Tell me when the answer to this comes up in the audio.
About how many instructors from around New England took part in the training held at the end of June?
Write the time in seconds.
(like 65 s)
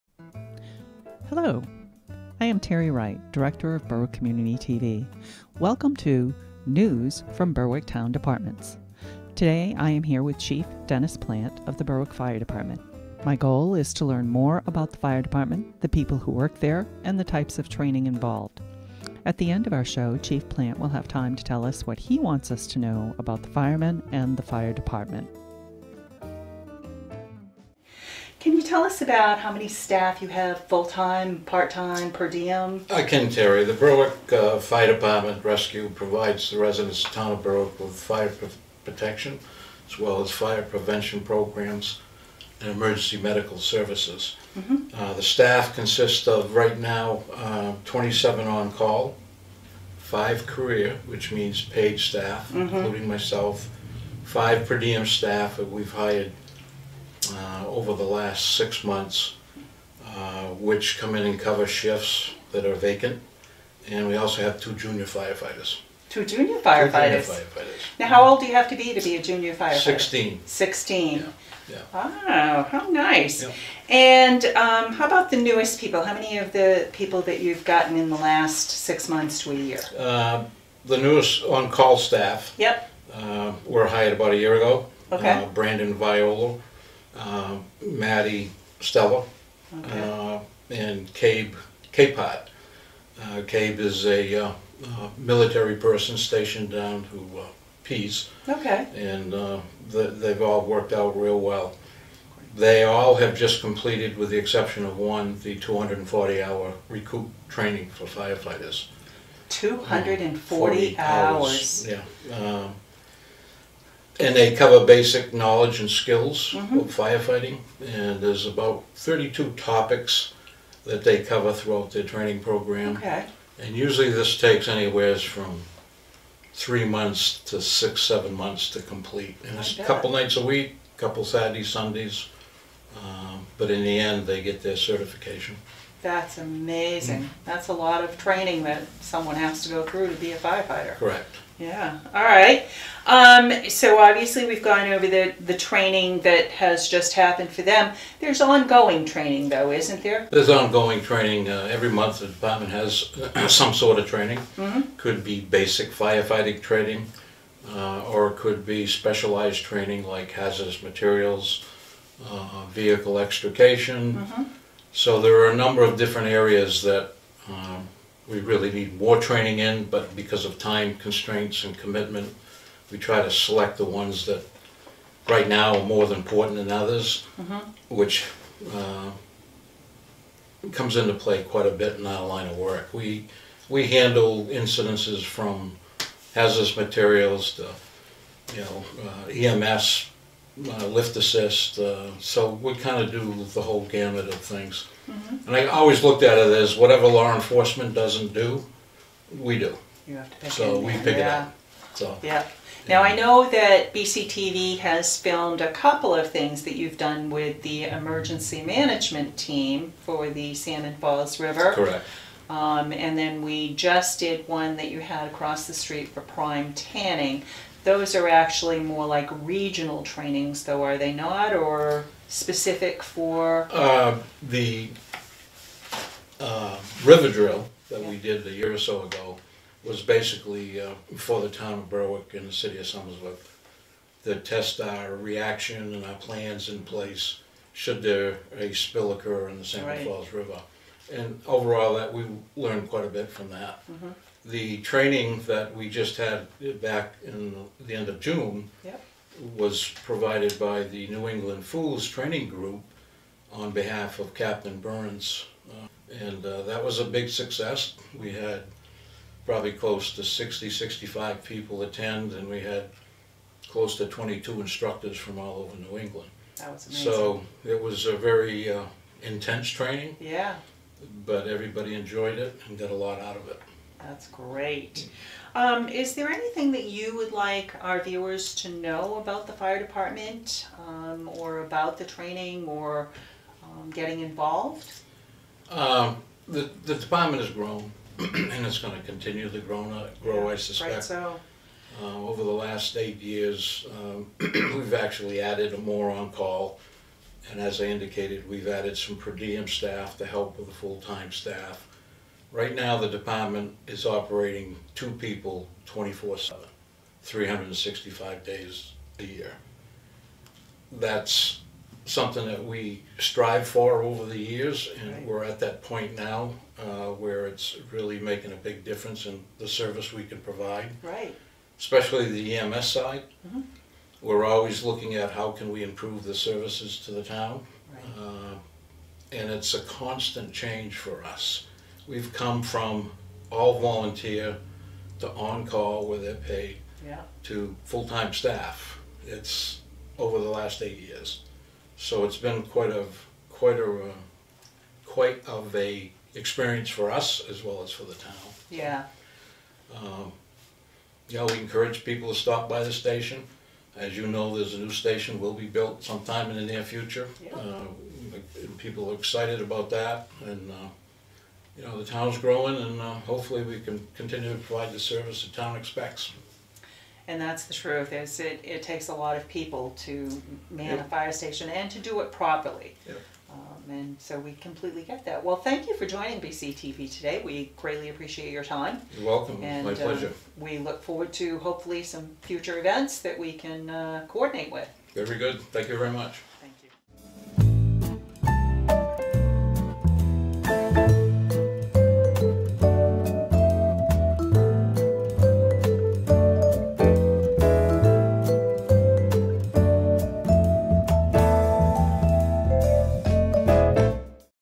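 264 s.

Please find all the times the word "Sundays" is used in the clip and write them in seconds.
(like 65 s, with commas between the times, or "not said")
131 s.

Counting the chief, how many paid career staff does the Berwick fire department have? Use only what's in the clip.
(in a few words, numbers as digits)
5.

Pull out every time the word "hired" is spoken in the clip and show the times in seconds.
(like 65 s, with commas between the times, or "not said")
56 s, 83 s.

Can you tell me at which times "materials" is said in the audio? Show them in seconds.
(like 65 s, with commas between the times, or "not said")
160 s, 186 s.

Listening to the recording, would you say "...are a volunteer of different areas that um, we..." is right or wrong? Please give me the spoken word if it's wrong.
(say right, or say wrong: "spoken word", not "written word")
wrong: "number", not "volunteer".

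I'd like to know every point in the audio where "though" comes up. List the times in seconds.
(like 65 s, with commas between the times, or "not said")
149 s, 220 s.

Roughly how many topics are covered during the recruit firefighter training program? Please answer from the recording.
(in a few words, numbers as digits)
32.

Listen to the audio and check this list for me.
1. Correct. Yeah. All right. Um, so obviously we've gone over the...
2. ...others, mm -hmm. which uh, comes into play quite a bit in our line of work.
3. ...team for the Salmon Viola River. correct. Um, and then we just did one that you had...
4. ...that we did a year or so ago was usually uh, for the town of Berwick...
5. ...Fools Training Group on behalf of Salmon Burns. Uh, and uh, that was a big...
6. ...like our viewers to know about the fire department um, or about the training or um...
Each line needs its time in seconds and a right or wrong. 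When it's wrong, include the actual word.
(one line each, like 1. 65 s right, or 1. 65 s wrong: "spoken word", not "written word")
1. 140 s right
2. 176 s right
3. 209 s wrong: "Falls", not "Viola"
4. 227 s wrong: "basically", not "usually"
5. 251 s wrong: "Captain", not "Salmon"
6. 277 s right.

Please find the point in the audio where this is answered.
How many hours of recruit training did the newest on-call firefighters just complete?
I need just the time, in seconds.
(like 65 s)
105 s.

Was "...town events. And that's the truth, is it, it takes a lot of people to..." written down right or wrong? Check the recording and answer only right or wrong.
wrong.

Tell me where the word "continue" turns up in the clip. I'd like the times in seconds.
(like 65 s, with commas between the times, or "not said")
289 s, 364 s.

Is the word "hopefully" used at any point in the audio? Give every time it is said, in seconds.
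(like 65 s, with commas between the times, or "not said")
363 s, 381 s.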